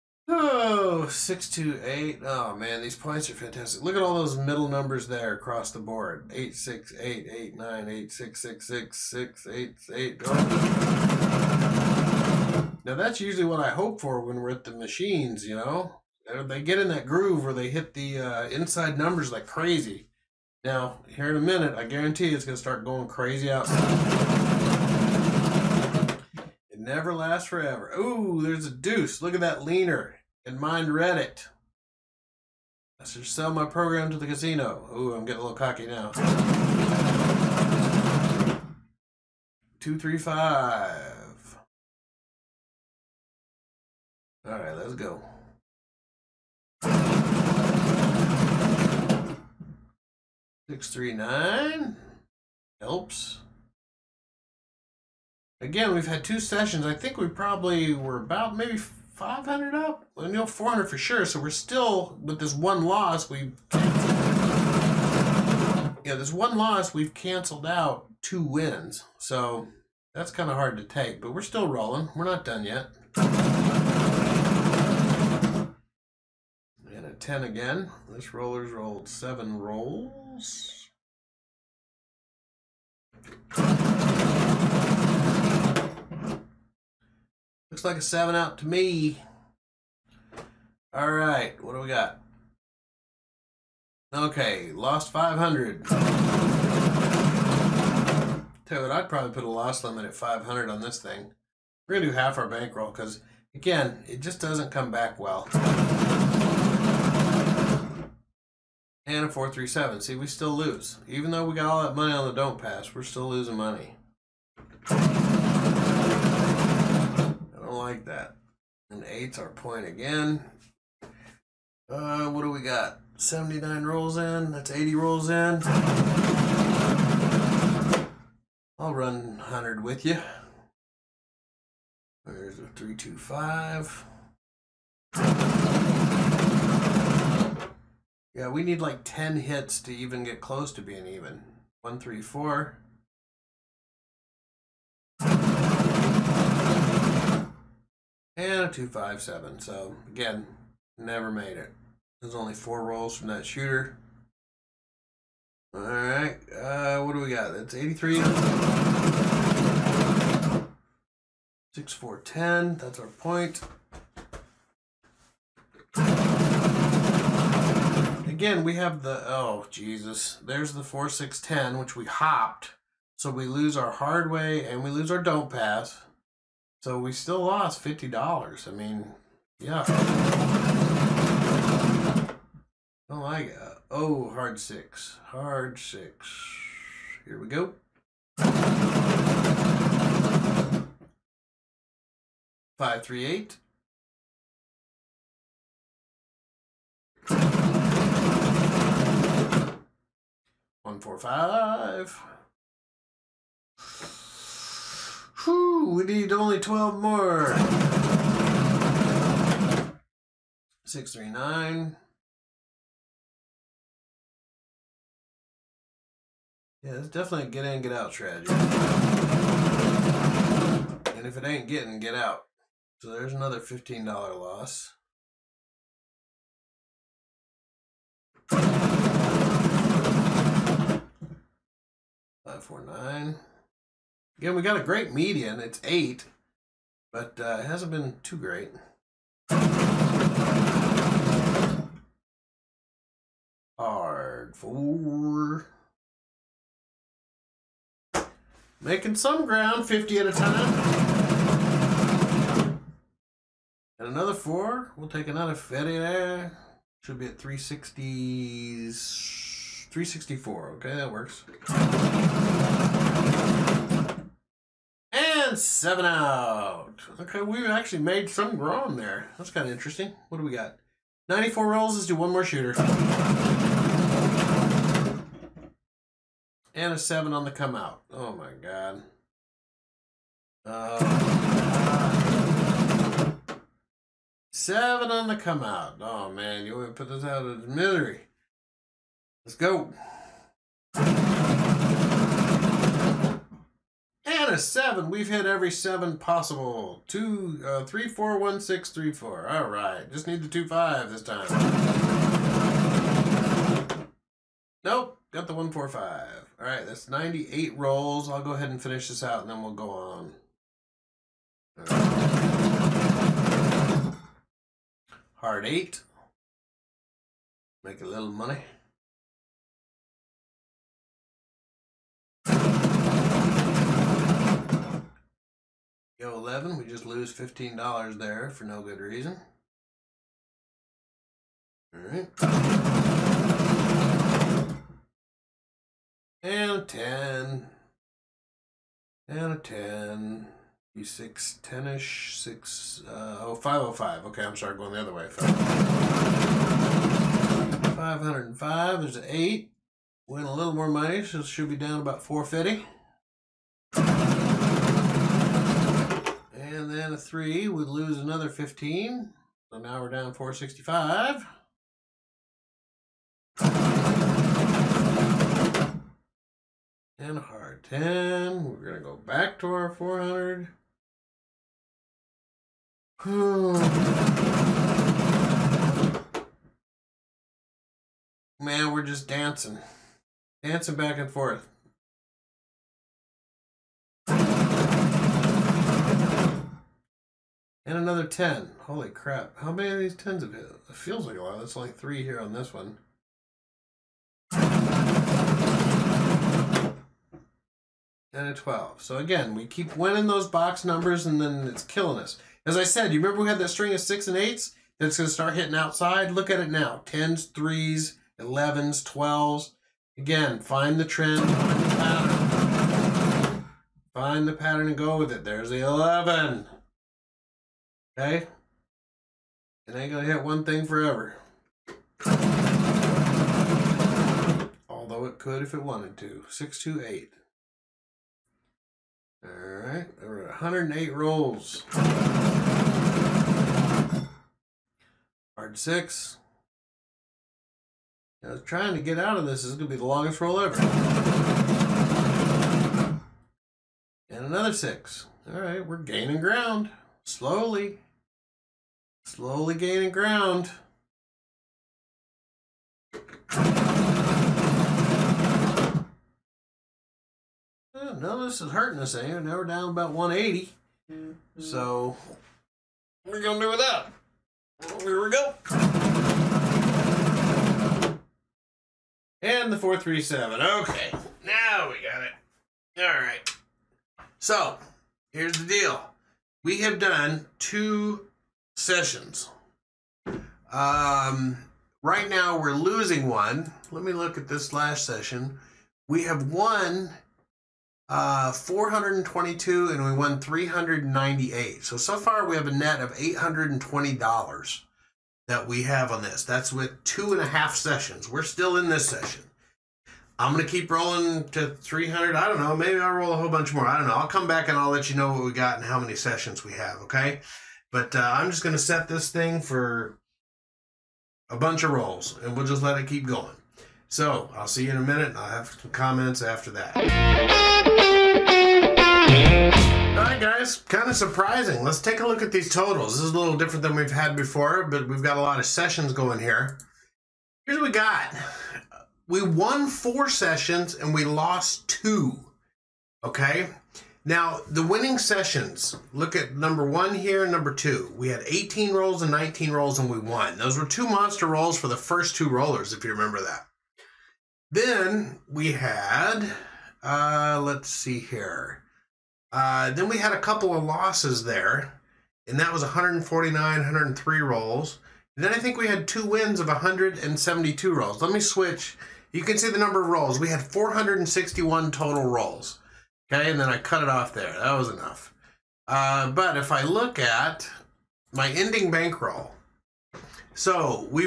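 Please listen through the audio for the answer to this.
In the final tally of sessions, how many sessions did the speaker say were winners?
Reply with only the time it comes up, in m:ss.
8:49.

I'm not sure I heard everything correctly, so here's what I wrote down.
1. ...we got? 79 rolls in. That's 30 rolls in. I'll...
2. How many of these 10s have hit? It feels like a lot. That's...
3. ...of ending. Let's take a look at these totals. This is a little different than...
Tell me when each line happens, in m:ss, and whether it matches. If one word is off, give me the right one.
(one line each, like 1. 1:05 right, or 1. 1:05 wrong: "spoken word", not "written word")
1. 2:02 wrong: "80", not "30"
2. 6:29 right
3. 8:41 wrong: "surprising", not "ending".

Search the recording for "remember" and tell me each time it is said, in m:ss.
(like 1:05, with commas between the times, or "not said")
6:43, 9:03.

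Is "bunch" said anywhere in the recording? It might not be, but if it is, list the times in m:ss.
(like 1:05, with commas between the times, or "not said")
8:23, 8:31.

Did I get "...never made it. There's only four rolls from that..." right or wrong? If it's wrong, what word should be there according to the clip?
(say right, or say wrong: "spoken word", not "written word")
right.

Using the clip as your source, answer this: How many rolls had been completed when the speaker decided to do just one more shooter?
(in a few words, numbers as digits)
94.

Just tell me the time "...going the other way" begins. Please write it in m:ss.
5:44.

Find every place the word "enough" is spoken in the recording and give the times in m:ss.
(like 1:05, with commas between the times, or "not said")
9:24.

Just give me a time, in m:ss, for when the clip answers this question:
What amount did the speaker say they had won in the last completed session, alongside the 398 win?
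8:08.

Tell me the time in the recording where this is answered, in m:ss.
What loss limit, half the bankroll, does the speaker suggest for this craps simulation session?
1:39.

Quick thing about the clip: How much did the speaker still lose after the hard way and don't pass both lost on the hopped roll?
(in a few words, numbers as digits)
$50.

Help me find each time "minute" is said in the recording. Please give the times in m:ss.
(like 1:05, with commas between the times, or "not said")
0:21, 8:35.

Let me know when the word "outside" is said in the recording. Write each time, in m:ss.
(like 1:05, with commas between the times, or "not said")
0:23, 6:45.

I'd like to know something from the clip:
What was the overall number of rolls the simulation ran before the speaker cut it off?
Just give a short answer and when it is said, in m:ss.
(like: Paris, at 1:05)
461, at 9:20.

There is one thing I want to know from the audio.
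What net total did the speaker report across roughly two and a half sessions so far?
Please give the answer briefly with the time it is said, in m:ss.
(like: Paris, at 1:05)
$820, at 8:13.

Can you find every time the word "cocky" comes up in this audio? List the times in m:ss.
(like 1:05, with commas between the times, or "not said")
0:35.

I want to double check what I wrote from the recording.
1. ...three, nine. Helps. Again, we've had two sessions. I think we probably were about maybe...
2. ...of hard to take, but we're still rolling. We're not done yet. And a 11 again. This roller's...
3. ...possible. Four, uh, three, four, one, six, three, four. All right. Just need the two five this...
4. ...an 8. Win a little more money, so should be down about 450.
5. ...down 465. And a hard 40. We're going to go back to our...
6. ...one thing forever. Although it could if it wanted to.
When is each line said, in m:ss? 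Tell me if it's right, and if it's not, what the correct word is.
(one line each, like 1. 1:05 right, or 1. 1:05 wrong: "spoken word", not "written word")
1. 0:50 right
2. 1:10 wrong: "10", not "11"
3. 4:56 wrong: "Two", not "Four"
4. 5:49 right
5. 6:00 wrong: "10", not "40"
6. 7:00 right.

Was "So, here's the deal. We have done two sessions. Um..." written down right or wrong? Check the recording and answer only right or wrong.
right.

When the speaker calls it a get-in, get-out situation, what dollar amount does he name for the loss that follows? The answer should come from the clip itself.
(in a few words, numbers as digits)
$15.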